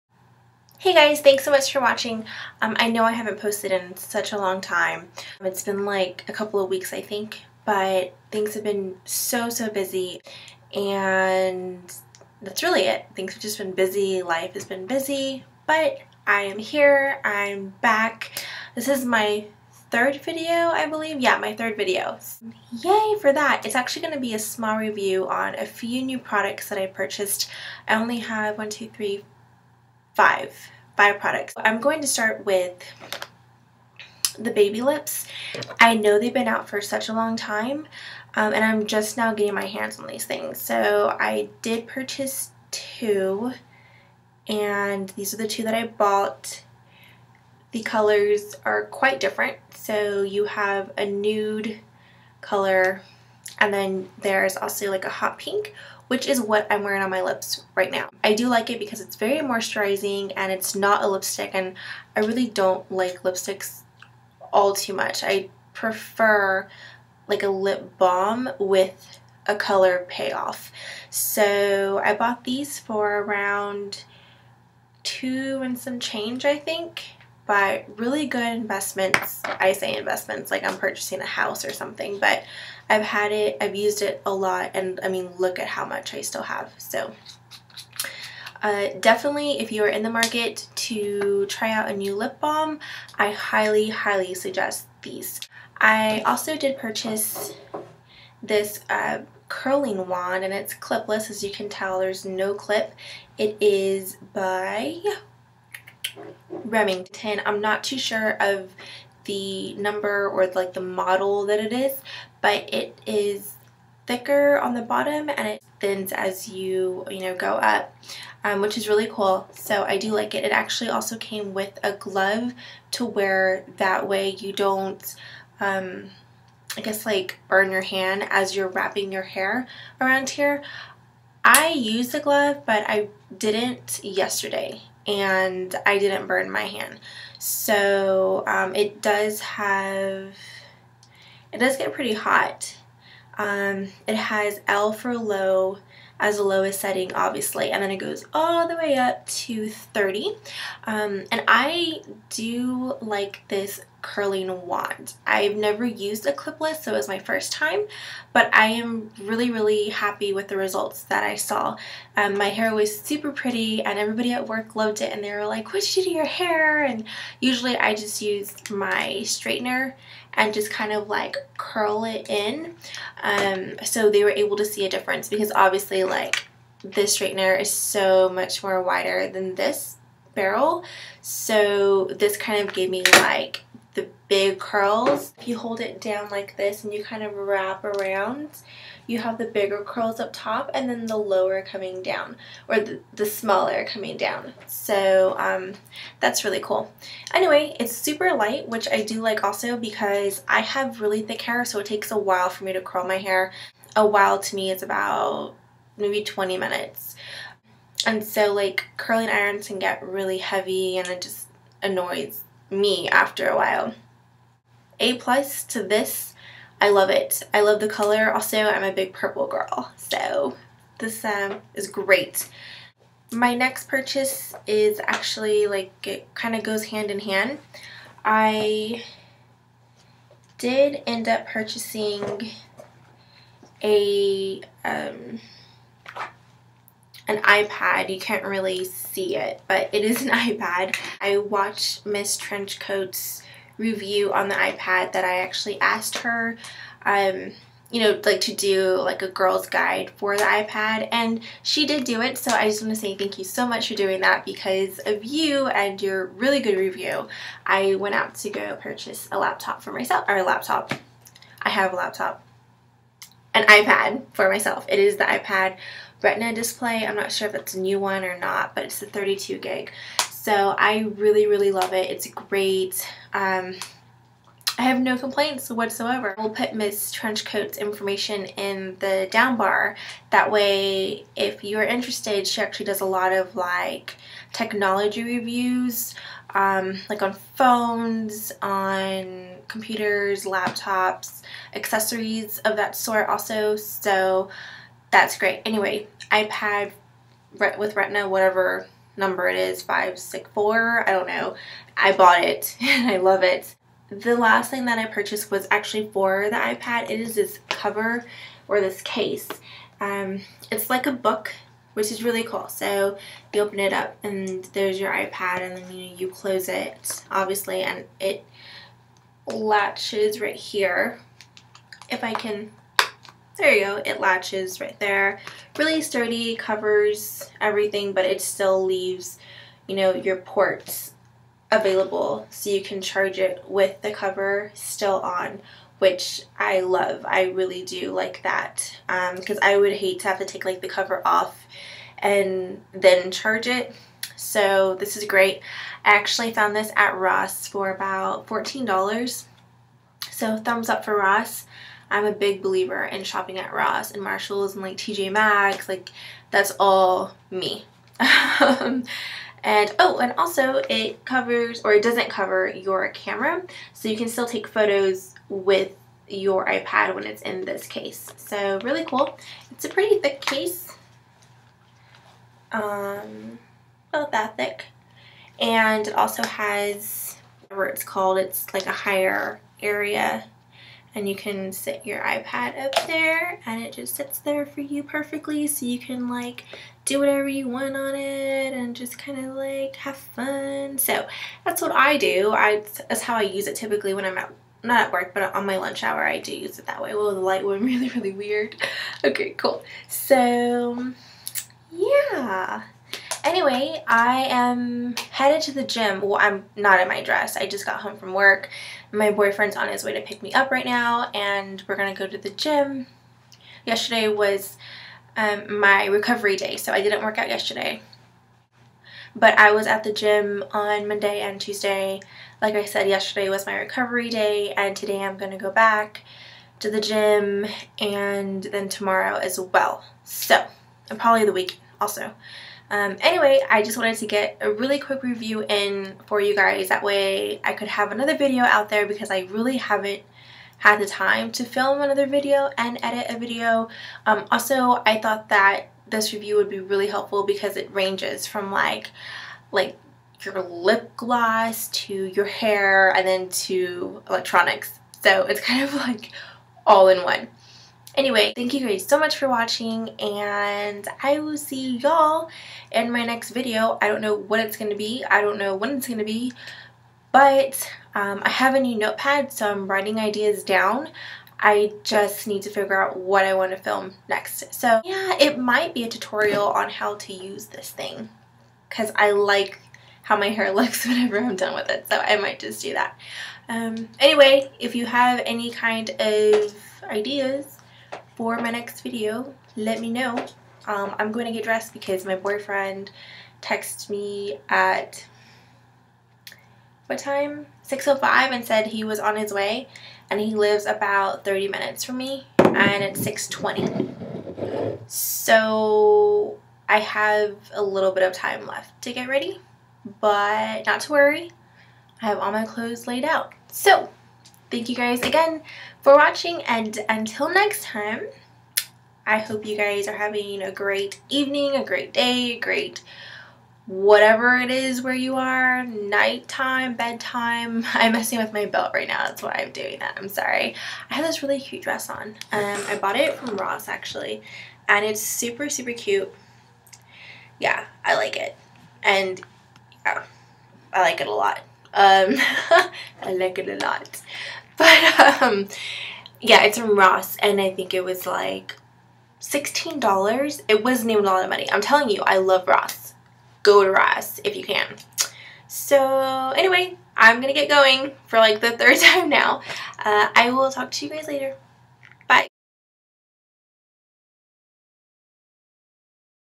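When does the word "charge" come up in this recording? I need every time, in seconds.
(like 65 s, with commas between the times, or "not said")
333 s, 343 s.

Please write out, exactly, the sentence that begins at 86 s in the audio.
So uh, definitely, if you are in the market to try out a new lip balm, I highly, highly suggest these.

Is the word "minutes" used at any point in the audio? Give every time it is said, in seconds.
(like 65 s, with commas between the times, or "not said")
206 s, 501 s.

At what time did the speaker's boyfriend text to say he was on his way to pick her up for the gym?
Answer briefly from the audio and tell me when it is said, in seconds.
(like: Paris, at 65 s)
6.05, at 497 s.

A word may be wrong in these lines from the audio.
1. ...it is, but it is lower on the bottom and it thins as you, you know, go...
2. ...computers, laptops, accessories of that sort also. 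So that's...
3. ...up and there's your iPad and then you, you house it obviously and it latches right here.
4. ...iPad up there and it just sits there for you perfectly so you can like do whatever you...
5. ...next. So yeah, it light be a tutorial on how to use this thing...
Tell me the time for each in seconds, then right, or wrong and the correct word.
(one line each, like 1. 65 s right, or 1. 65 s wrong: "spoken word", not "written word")
1. 111 s wrong: "thicker", not "lower"
2. 289 s right
3. 313 s wrong: "close", not "house"
4. 382 s right
5. 474 s wrong: "might", not "light".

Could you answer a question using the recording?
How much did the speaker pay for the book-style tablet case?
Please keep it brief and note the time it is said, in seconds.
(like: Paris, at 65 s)
$14, at 348 s.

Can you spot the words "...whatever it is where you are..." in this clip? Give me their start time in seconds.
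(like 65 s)
523 s.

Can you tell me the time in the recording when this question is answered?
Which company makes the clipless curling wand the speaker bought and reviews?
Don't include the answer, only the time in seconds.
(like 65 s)
106 s.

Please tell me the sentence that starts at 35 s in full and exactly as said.
I know they've been out for such a long time um, and I'm just now getting my hands on these things.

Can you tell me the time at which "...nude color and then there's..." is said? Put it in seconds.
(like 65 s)
51 s.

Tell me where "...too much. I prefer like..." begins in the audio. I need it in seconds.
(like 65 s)
64 s.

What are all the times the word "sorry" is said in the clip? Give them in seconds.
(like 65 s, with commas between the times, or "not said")
530 s.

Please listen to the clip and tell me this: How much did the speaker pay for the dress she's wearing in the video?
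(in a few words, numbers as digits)
$16.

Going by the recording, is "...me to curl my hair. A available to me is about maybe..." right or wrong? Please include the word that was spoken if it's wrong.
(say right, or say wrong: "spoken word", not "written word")
wrong: "while", not "available".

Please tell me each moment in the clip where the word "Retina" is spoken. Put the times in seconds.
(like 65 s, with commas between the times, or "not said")
266 s, 297 s.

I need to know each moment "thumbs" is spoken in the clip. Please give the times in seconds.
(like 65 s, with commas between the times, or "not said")
350 s.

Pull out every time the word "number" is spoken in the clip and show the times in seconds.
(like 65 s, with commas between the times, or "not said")
109 s, 299 s.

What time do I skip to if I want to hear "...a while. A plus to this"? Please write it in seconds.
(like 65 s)
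213 s.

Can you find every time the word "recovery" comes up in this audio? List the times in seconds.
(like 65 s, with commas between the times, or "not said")
416 s, 423 s.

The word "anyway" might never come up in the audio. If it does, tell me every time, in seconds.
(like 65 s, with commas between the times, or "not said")
197 s, 295 s, 403 s, 433 s, 458 s, 484 s, 556 s.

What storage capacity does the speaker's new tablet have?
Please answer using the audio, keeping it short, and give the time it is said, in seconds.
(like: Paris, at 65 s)
32 gig, at 269 s.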